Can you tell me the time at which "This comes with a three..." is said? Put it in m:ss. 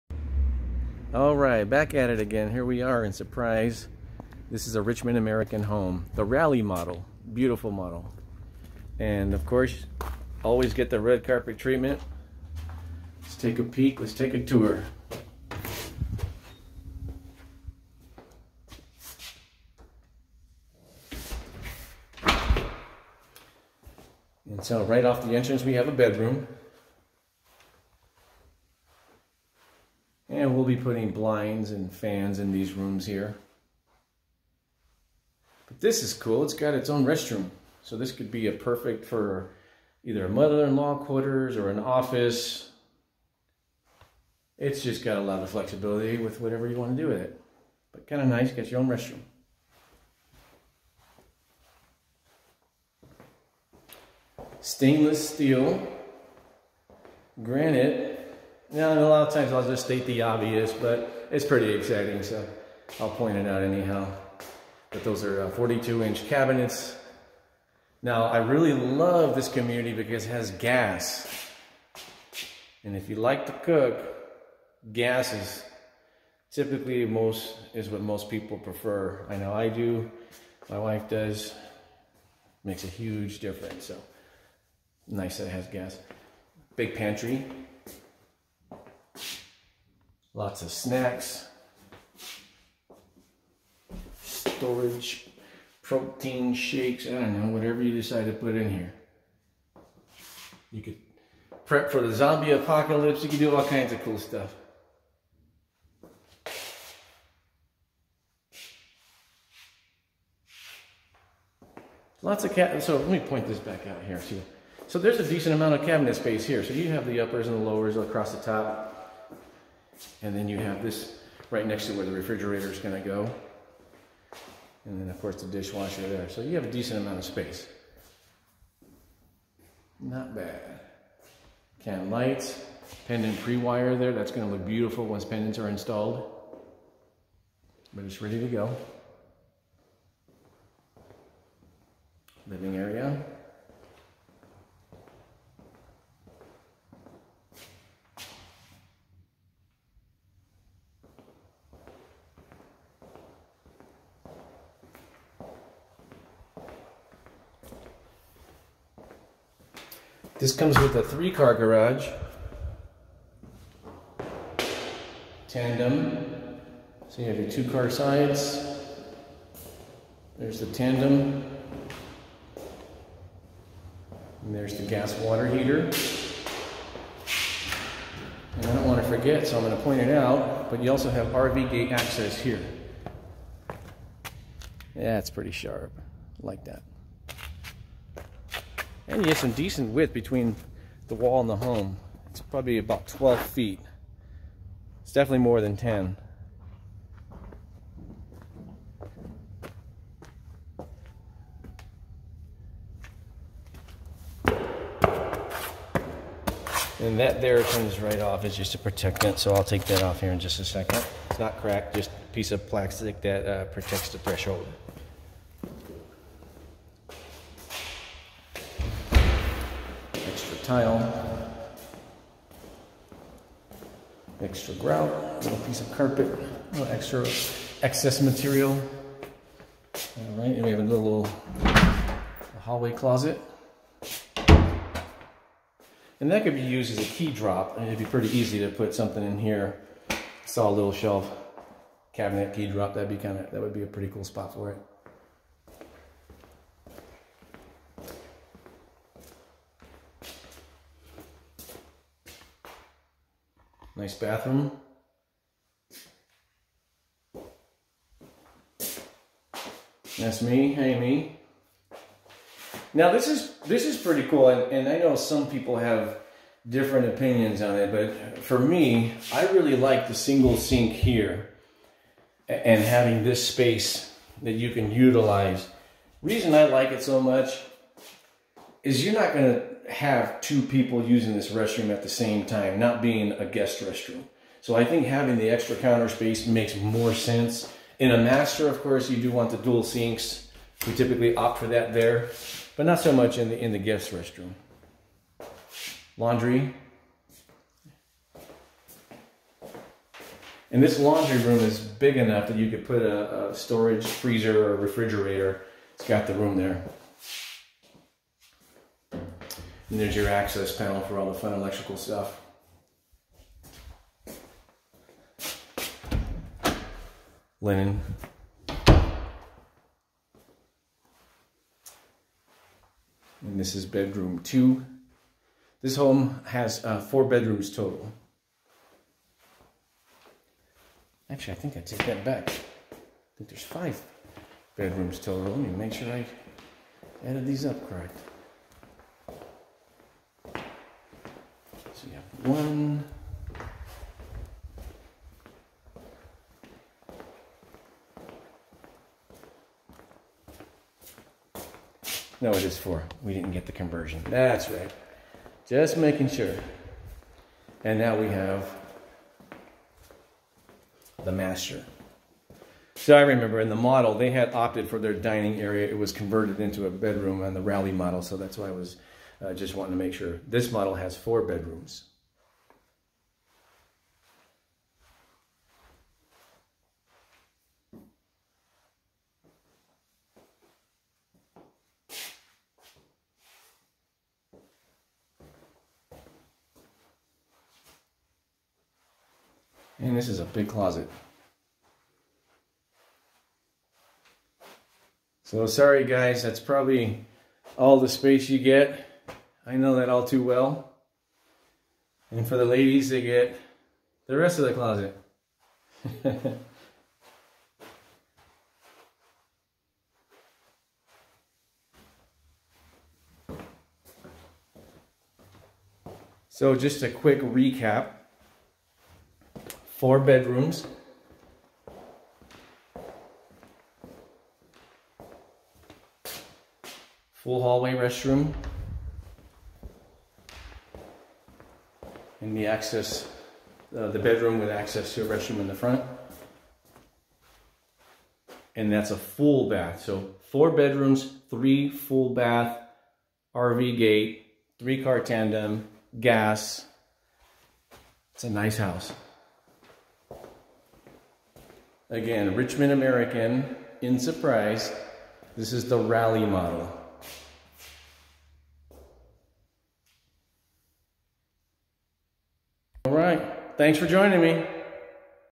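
2:40.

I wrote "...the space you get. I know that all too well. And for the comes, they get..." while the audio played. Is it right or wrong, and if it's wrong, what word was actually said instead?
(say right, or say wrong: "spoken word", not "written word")
wrong: "ladies", not "comes".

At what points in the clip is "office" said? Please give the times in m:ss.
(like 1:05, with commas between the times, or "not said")
0:41.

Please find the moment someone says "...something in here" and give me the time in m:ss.
3:58.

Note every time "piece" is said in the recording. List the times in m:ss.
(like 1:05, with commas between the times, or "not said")
3:32, 3:45.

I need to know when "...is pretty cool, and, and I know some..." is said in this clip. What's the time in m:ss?
4:23.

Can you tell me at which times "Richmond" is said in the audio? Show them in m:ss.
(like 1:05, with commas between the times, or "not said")
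0:04, 7:32.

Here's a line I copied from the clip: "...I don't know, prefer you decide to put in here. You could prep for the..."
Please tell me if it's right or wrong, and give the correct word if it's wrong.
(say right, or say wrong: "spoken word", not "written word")
wrong: "whatever", not "prefer".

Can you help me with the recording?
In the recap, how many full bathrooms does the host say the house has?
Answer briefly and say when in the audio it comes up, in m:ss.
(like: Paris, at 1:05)
3, at 7:21.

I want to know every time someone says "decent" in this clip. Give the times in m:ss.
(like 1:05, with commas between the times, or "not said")
1:55, 2:06, 3:09.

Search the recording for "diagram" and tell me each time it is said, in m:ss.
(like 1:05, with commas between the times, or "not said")
not said.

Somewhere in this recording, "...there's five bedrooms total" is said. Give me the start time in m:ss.
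5:33.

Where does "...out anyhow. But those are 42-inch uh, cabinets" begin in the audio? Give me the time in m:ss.
1:03.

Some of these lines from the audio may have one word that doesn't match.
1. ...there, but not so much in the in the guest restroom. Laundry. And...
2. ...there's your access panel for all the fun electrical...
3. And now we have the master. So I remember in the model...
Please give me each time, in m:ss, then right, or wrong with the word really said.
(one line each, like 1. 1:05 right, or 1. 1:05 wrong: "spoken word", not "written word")
1. 4:51 right
2. 5:09 right
3. 5:57 right.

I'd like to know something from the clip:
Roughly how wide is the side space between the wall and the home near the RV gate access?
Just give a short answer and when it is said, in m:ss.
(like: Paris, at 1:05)
about 12 feet, at 3:12.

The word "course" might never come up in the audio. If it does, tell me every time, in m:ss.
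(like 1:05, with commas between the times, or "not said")
0:09, 2:05, 4:48.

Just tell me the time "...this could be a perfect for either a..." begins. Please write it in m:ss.
0:37.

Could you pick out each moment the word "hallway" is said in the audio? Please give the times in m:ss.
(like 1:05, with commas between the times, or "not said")
3:52, 7:07.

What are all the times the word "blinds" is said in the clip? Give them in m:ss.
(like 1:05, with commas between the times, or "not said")
0:31.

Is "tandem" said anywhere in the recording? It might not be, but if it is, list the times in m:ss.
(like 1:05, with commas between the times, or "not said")
2:45, 2:50, 7:25.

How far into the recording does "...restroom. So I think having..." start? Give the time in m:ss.
4:43.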